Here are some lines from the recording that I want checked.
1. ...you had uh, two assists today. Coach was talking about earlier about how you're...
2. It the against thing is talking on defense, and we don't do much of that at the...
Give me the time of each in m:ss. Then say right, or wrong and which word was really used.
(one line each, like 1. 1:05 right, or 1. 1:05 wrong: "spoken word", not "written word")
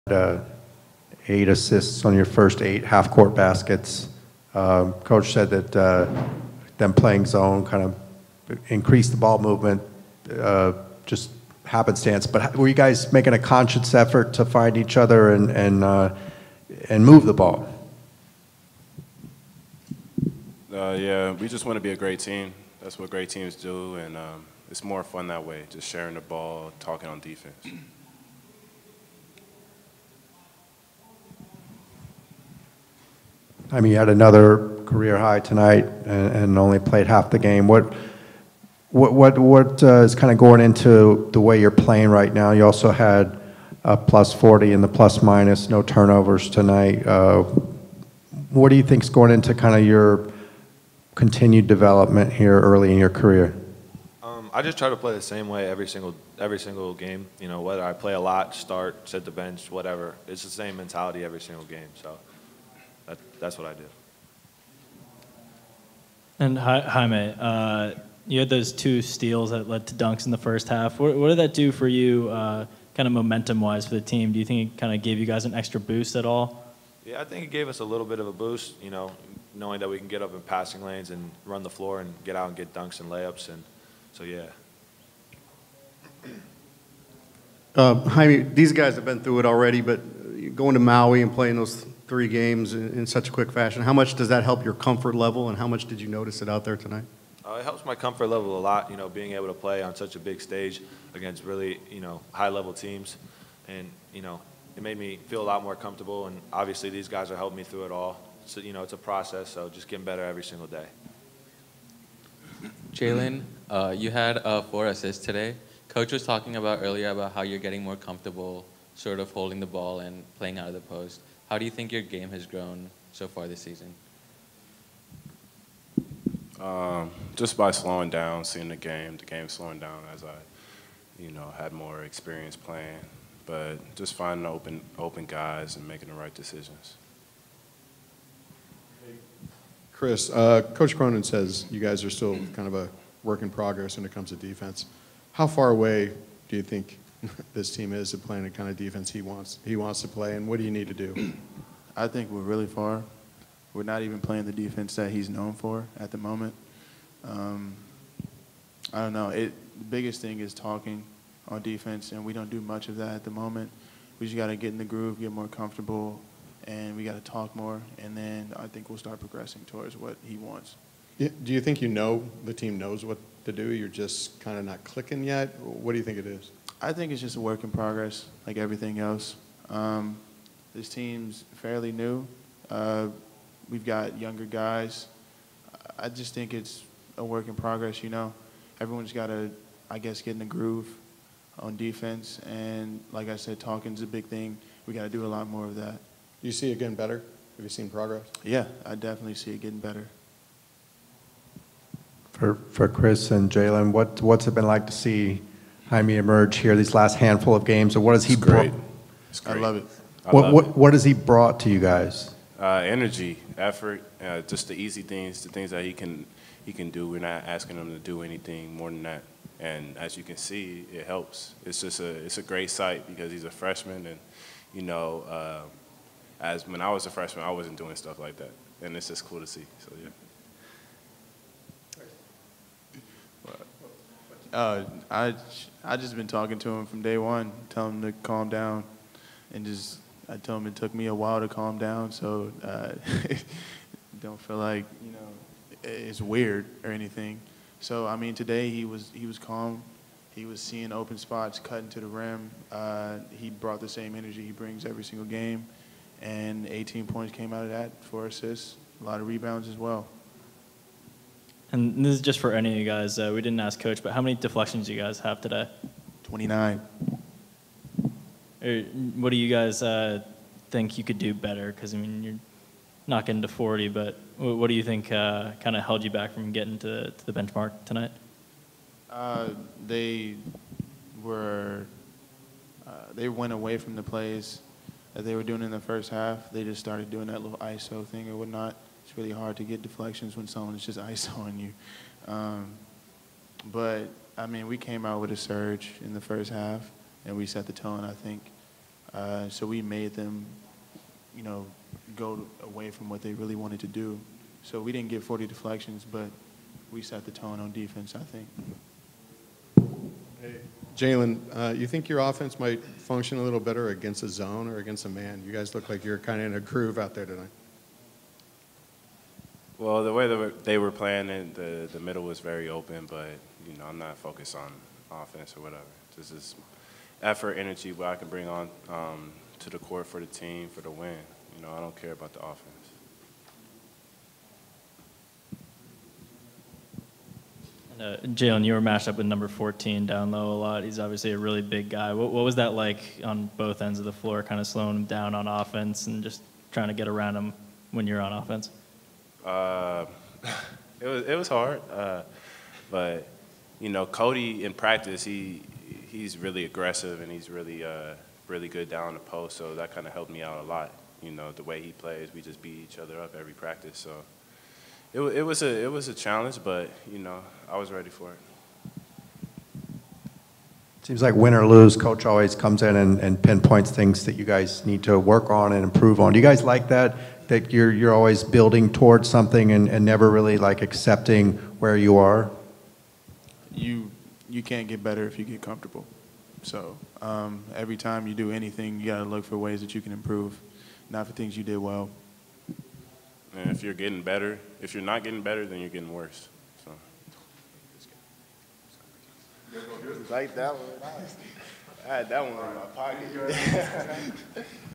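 1. 1:53 wrong: "four", not "two"
2. 2:39 wrong: "biggest", not "against".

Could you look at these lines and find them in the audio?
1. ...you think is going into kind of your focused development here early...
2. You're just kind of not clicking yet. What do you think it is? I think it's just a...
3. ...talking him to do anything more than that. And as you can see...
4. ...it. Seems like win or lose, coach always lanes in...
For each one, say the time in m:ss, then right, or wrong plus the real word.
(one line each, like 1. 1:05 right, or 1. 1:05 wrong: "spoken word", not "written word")
1. 0:48 wrong: "continued", not "focused"
2. 2:53 right
3. 3:37 wrong: "asking", not "talking"
4. 6:08 wrong: "comes", not "lanes".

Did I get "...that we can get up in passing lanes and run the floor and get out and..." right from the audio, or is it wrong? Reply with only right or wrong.
right.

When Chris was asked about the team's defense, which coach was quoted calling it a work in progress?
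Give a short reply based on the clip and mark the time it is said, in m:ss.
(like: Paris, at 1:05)
Coach Cronin, at 2:20.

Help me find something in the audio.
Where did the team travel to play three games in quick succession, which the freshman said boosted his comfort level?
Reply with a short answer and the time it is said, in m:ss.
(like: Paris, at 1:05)
Maui, at 1:30.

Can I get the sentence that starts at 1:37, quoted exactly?
Uh, it helps my comfort level a lot.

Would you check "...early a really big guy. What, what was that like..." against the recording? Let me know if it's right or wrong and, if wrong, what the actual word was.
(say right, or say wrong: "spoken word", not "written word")
wrong: "obviously", not "early".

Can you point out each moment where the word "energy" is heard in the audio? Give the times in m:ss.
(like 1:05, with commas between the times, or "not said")
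3:32, 4:14, 5:27.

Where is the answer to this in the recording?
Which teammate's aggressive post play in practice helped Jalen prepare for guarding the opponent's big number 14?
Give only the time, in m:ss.
5:54.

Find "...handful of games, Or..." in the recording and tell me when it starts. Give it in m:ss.
3:27.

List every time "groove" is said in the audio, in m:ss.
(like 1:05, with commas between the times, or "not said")
2:44, 3:10, 5:16.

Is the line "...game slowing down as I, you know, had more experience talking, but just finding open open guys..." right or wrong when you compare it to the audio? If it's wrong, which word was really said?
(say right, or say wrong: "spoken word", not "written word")
wrong: "playing", not "talking".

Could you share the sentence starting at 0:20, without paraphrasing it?
Uh, yeah, we just want to be a great team.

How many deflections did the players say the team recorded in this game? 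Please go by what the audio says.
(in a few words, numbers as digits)
29.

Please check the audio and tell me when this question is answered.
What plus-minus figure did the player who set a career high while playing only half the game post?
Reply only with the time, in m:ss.
0:43.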